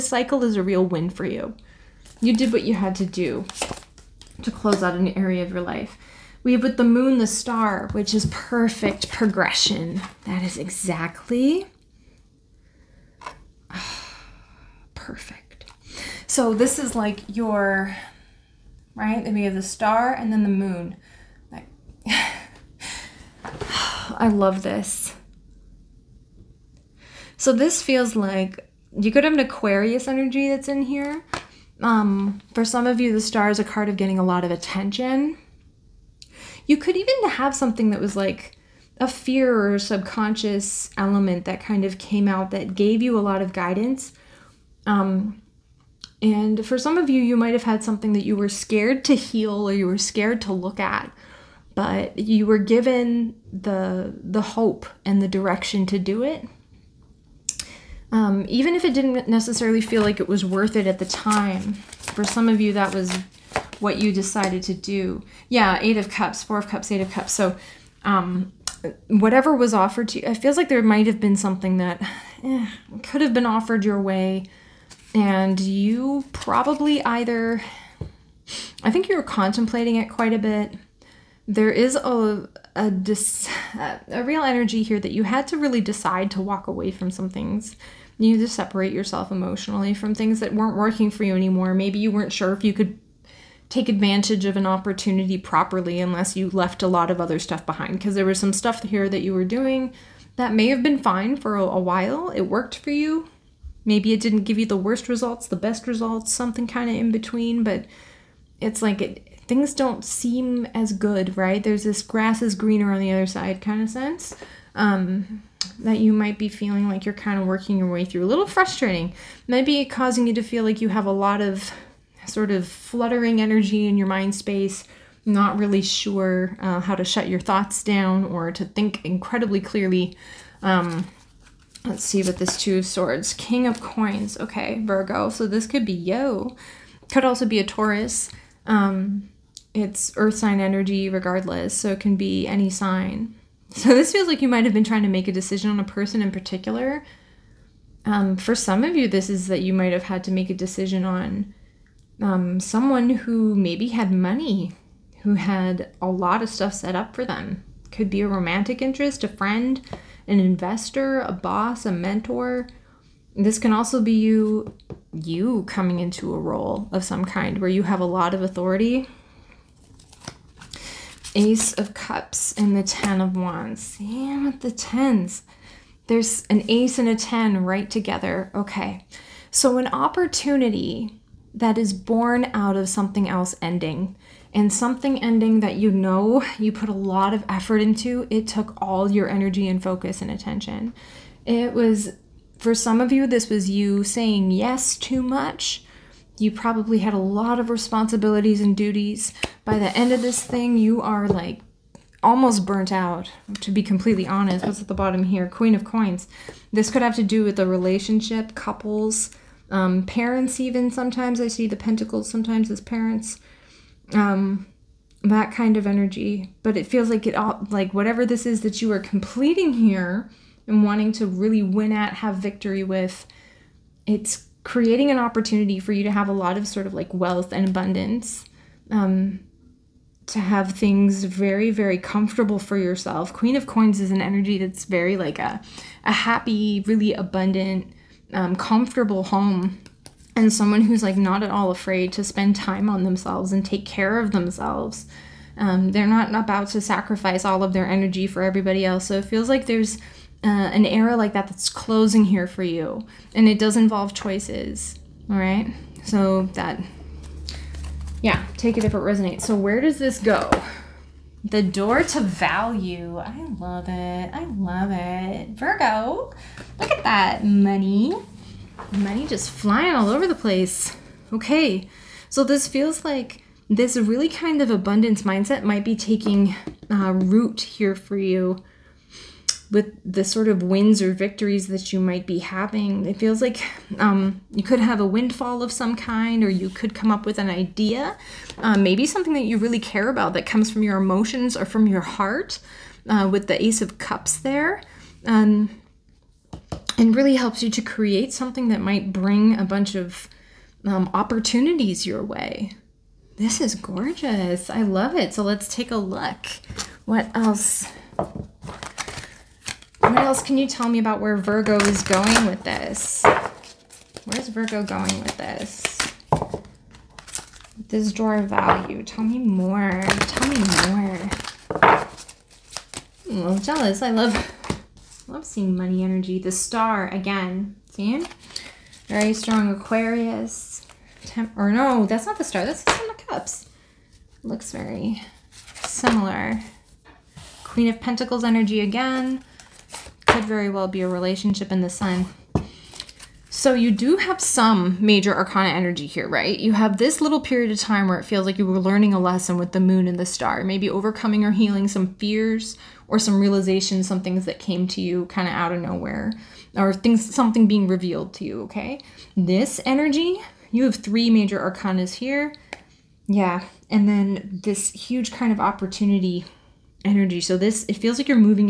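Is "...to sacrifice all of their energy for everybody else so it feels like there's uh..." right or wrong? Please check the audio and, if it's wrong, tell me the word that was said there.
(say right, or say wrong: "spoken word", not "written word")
right.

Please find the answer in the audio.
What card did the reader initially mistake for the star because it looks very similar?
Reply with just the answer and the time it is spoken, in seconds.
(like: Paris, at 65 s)
Seven of Cups, at 332 s.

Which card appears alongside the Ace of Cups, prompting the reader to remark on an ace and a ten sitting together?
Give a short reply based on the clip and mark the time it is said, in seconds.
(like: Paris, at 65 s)
Ten of Wands, at 172 s.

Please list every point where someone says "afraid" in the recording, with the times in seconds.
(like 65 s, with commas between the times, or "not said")
241 s.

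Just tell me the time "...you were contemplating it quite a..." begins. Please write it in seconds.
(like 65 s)
79 s.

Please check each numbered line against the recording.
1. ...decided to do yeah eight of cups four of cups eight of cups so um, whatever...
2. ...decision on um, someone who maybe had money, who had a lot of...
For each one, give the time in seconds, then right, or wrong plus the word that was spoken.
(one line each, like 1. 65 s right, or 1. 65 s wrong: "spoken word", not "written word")
1. 64 s right
2. 150 s right.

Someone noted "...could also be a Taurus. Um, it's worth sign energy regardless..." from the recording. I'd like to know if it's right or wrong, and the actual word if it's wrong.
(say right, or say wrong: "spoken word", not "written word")
wrong: "earth", not "worth".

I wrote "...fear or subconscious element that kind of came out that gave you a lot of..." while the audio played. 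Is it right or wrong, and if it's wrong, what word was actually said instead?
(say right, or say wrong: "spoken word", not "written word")
right.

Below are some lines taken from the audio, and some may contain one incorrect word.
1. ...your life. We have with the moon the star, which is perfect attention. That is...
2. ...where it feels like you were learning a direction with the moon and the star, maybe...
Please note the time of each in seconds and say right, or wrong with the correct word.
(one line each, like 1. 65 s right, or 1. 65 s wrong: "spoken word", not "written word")
1. 5 s wrong: "progression", not "attention"
2. 348 s wrong: "lesson", not "direction".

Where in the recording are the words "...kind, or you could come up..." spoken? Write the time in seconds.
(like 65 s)
285 s.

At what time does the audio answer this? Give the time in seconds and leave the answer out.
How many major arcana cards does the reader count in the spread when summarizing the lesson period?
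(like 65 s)
360 s.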